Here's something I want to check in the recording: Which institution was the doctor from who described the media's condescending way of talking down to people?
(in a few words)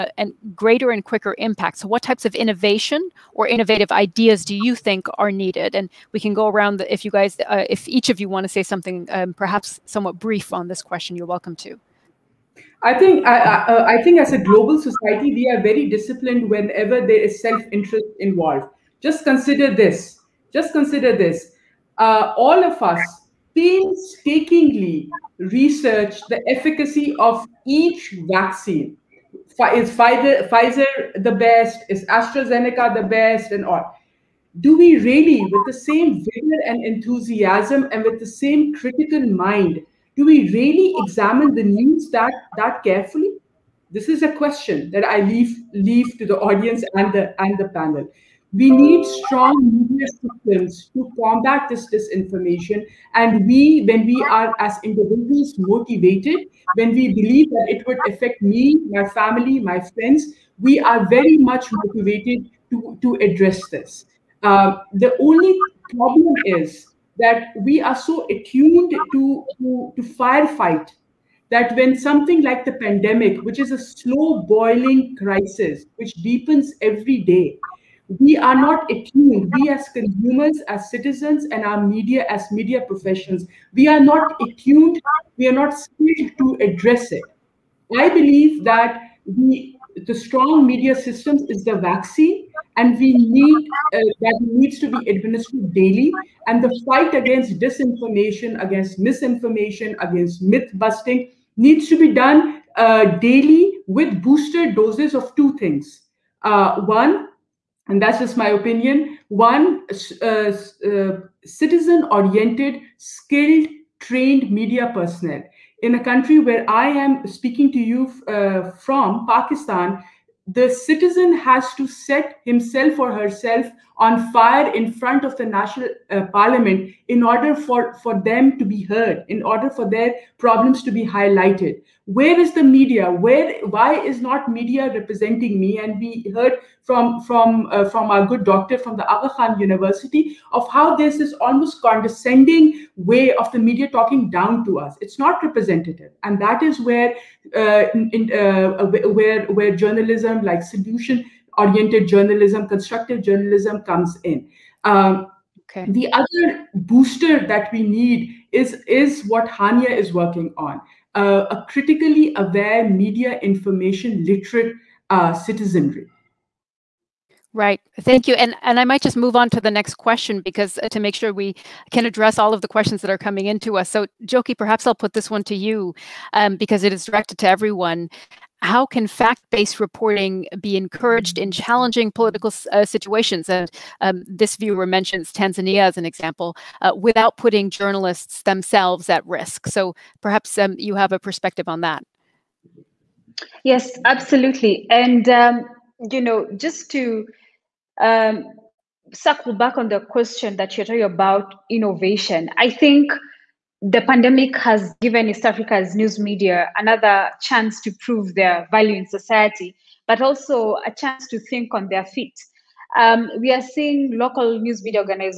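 Aga Khan University.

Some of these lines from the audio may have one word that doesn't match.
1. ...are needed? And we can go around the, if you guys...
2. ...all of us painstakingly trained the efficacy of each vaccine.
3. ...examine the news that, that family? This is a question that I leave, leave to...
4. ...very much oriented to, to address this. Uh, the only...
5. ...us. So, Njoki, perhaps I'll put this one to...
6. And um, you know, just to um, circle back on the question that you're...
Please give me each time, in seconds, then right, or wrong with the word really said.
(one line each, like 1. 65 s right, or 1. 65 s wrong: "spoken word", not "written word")
1. 5 s right
2. 22 s wrong: "researched", not "trained"
3. 40 s wrong: "carefully", not "family"
4. 61 s wrong: "motivated", not "oriented"
5. 173 s right
6. 194 s right.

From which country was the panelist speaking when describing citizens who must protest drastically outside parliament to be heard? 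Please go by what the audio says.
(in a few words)
Pakistan.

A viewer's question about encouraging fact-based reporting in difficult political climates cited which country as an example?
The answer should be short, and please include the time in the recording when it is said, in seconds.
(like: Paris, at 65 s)
Tanzania, at 185 s.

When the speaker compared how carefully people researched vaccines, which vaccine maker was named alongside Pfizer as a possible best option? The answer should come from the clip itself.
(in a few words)
AstraZeneca.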